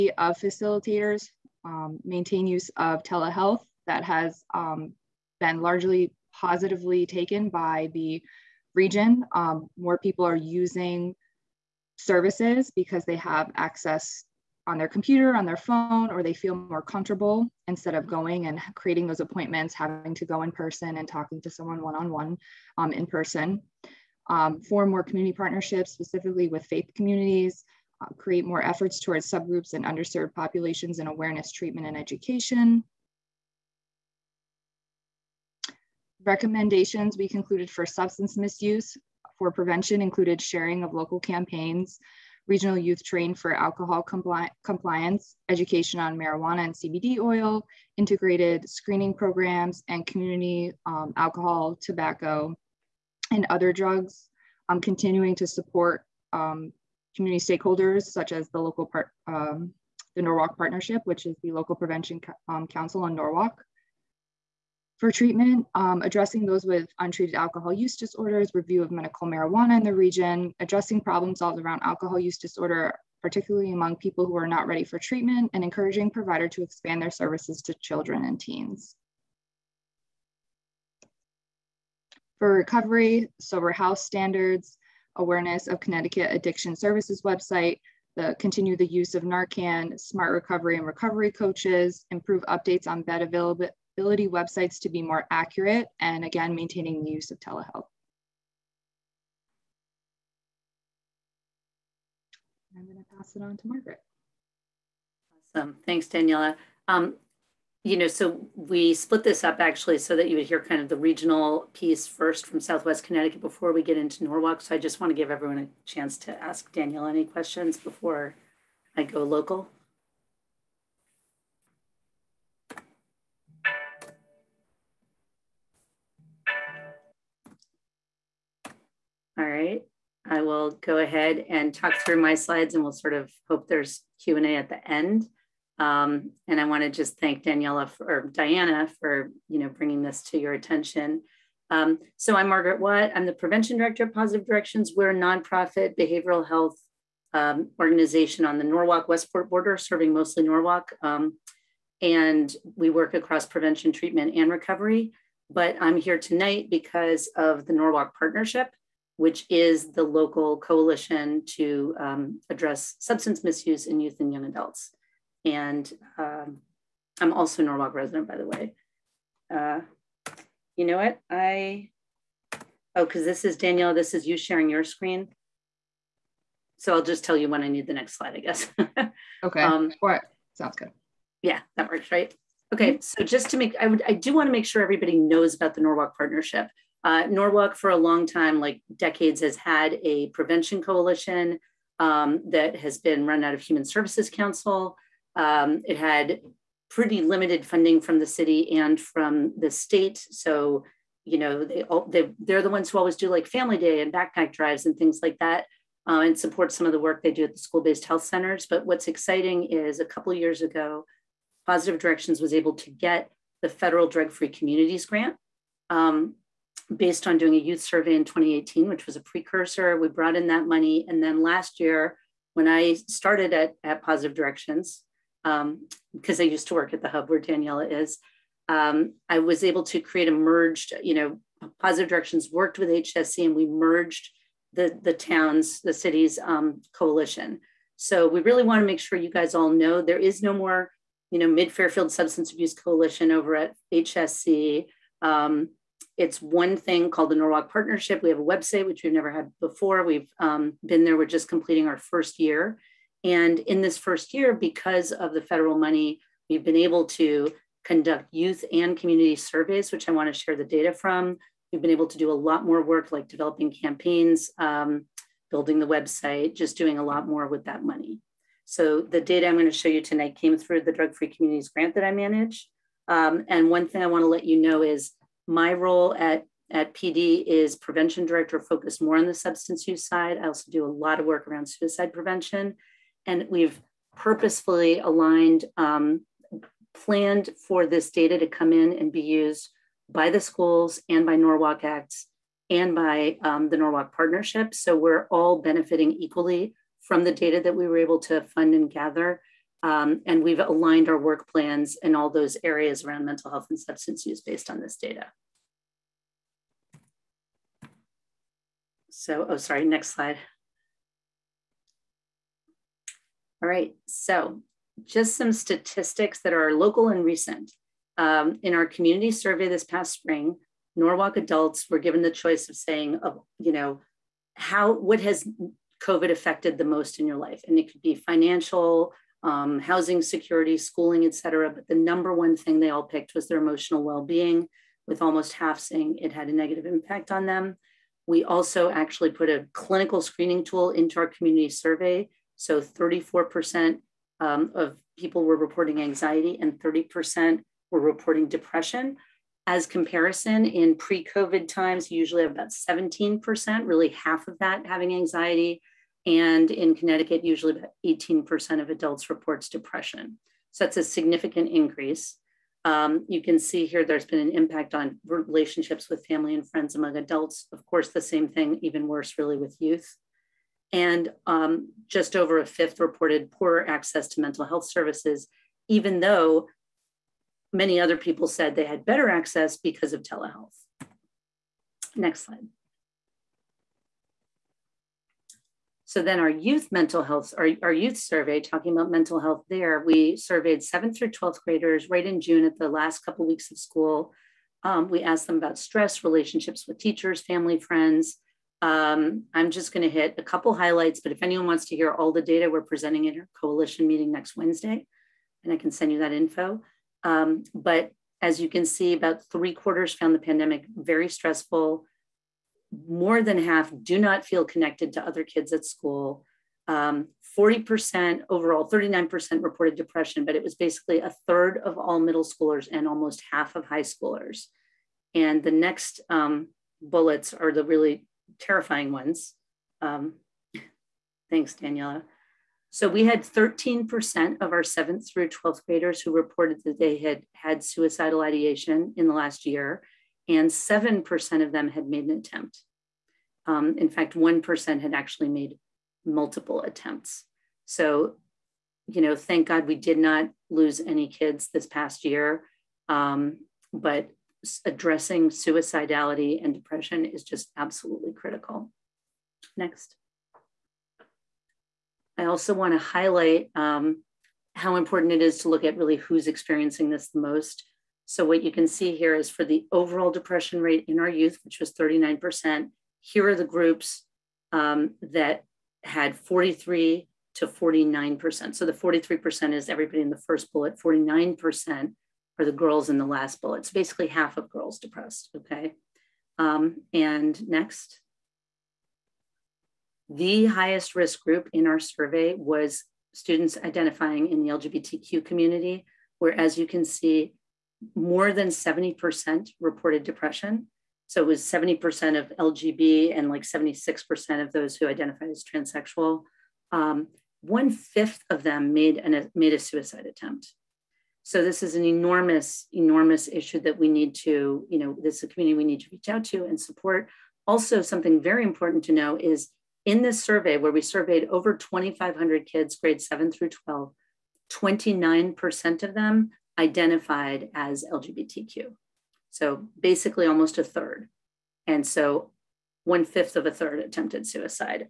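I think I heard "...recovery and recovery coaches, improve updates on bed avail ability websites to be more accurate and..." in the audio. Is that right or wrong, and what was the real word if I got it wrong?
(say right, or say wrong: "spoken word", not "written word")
right.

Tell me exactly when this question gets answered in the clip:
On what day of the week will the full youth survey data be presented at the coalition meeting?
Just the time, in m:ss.
6:44.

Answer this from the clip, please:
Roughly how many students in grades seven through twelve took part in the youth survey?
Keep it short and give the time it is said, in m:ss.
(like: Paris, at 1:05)
Over 2,500, at 8:41.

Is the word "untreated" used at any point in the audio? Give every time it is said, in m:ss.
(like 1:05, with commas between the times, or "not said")
1:06.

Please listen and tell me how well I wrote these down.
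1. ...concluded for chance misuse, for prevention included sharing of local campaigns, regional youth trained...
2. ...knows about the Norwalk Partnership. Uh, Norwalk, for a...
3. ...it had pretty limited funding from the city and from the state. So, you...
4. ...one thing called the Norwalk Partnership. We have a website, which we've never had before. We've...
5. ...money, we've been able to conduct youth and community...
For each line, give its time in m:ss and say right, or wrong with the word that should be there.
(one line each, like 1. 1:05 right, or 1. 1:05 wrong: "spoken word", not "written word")
1. 0:37 wrong: "substance", not "chance"
2. 3:05 right
3. 3:15 right
4. 4:06 right
5. 4:15 right.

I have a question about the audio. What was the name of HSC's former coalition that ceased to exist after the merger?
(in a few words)
Mid Fairfield Substance Abuse Coalition.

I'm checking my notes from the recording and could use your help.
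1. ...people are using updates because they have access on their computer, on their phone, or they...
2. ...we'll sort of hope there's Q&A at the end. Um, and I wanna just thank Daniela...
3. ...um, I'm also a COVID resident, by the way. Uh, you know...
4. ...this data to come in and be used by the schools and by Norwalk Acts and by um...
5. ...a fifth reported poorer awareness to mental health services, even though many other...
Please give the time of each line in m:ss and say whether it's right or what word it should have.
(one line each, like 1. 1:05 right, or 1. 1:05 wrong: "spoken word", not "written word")
1. 0:09 wrong: "services", not "updates"
2. 2:12 right
3. 2:46 wrong: "Norwalk", not "COVID"
4. 4:47 right
5. 6:12 wrong: "access", not "awareness".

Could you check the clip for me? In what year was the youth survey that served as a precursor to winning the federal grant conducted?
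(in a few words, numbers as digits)
2018.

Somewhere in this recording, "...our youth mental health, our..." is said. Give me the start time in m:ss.
6:26.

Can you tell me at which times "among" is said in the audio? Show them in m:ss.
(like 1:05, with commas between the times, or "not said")
1:13, 6:06.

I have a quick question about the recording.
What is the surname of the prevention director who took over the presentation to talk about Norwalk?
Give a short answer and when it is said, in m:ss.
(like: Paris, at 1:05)
Watt, at 2:22.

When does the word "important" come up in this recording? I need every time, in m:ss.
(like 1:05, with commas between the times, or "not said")
7:44, 8:38.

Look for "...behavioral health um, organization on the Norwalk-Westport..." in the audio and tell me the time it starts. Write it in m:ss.
2:25.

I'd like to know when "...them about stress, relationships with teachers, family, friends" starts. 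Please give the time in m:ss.
6:35.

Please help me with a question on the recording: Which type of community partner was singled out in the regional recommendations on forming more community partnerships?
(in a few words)
Faith communities.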